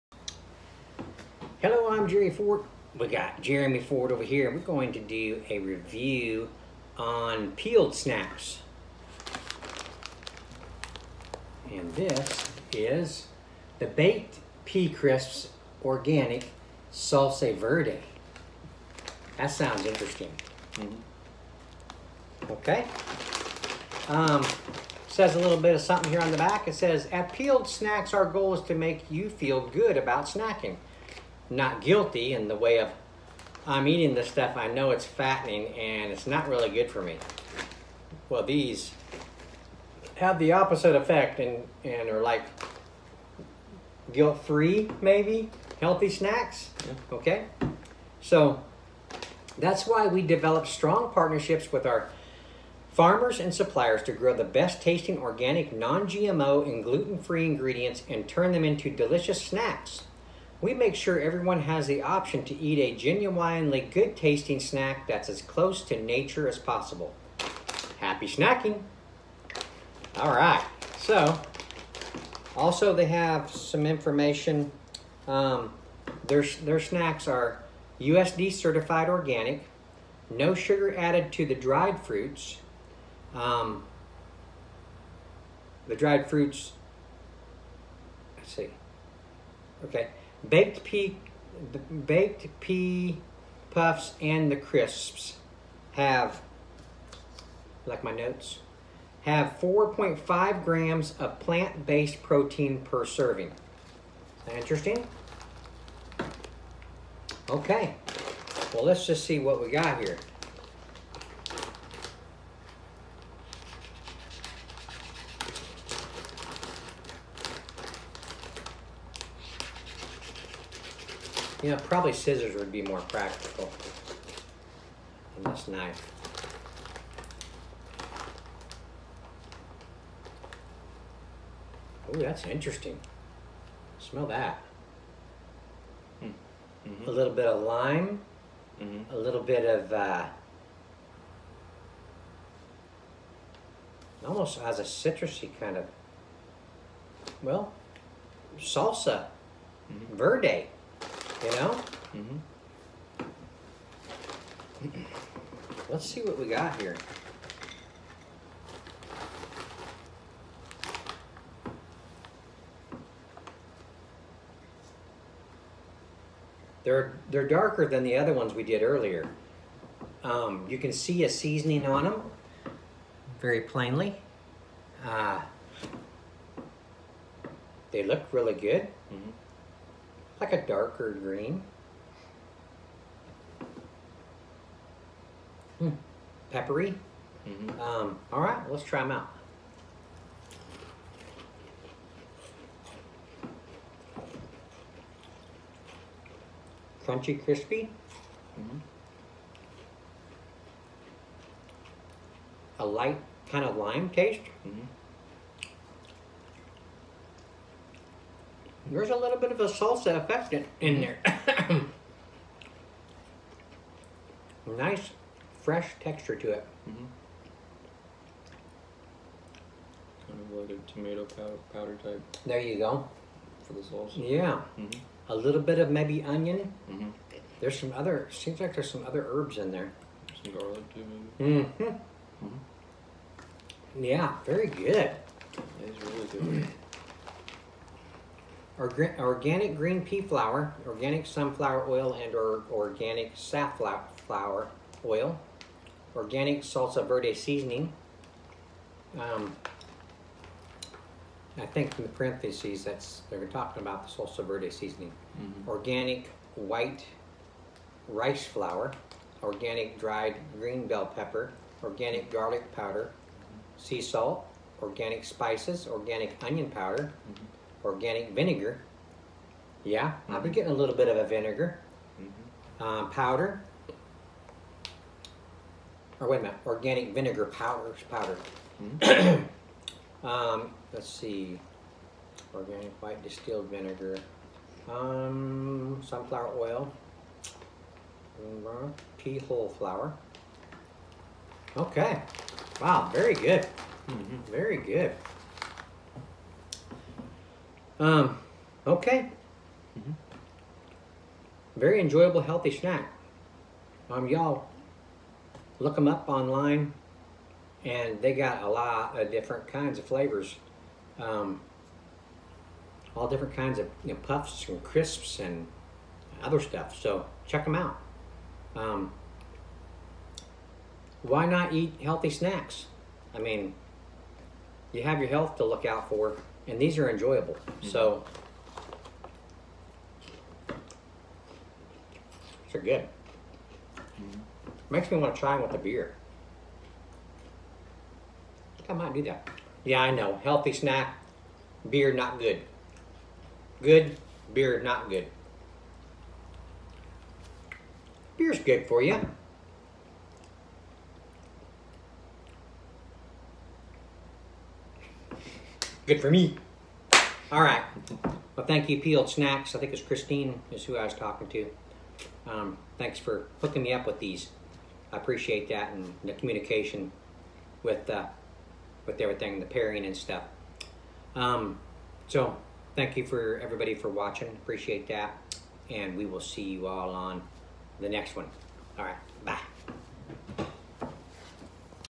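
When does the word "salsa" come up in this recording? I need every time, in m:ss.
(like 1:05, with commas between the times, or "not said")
0:16, 2:28, 3:29, 3:43, 4:06, 4:14.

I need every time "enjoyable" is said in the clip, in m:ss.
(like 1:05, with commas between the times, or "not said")
5:02, 5:27.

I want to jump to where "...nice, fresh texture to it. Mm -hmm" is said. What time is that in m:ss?
3:34.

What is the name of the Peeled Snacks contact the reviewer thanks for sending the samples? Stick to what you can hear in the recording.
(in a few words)
Christine.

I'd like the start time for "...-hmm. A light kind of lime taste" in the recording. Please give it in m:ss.
3:18.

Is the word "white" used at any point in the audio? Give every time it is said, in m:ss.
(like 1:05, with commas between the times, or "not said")
4:16, 4:43.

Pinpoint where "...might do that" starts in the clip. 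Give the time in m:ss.
5:38.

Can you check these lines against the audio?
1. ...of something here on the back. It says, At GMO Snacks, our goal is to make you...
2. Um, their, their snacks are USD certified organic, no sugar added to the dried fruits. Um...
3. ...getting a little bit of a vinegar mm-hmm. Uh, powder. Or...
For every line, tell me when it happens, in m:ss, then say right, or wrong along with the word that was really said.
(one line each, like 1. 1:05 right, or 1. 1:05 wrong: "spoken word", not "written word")
1. 0:25 wrong: "Peeled", not "GMO"
2. 1:15 right
3. 4:30 right.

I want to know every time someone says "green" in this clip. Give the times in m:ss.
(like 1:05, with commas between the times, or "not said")
3:01, 3:59, 4:20.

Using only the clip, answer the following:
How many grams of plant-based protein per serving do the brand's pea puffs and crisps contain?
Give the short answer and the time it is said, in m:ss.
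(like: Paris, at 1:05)
4.5, at 1:39.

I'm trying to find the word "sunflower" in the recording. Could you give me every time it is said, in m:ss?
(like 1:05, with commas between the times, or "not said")
4:01, 4:46.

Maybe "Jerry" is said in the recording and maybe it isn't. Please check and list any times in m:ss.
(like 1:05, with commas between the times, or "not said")
0:02.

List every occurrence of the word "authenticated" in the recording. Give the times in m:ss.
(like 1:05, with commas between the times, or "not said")
not said.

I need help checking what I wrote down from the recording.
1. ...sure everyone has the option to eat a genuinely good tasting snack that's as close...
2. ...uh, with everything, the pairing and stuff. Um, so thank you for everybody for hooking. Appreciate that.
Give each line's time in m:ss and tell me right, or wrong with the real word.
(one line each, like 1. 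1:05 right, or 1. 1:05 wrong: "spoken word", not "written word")
1. 1:00 right
2. 6:08 wrong: "watching", not "hooking".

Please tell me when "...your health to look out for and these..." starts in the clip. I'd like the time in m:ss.
5:25.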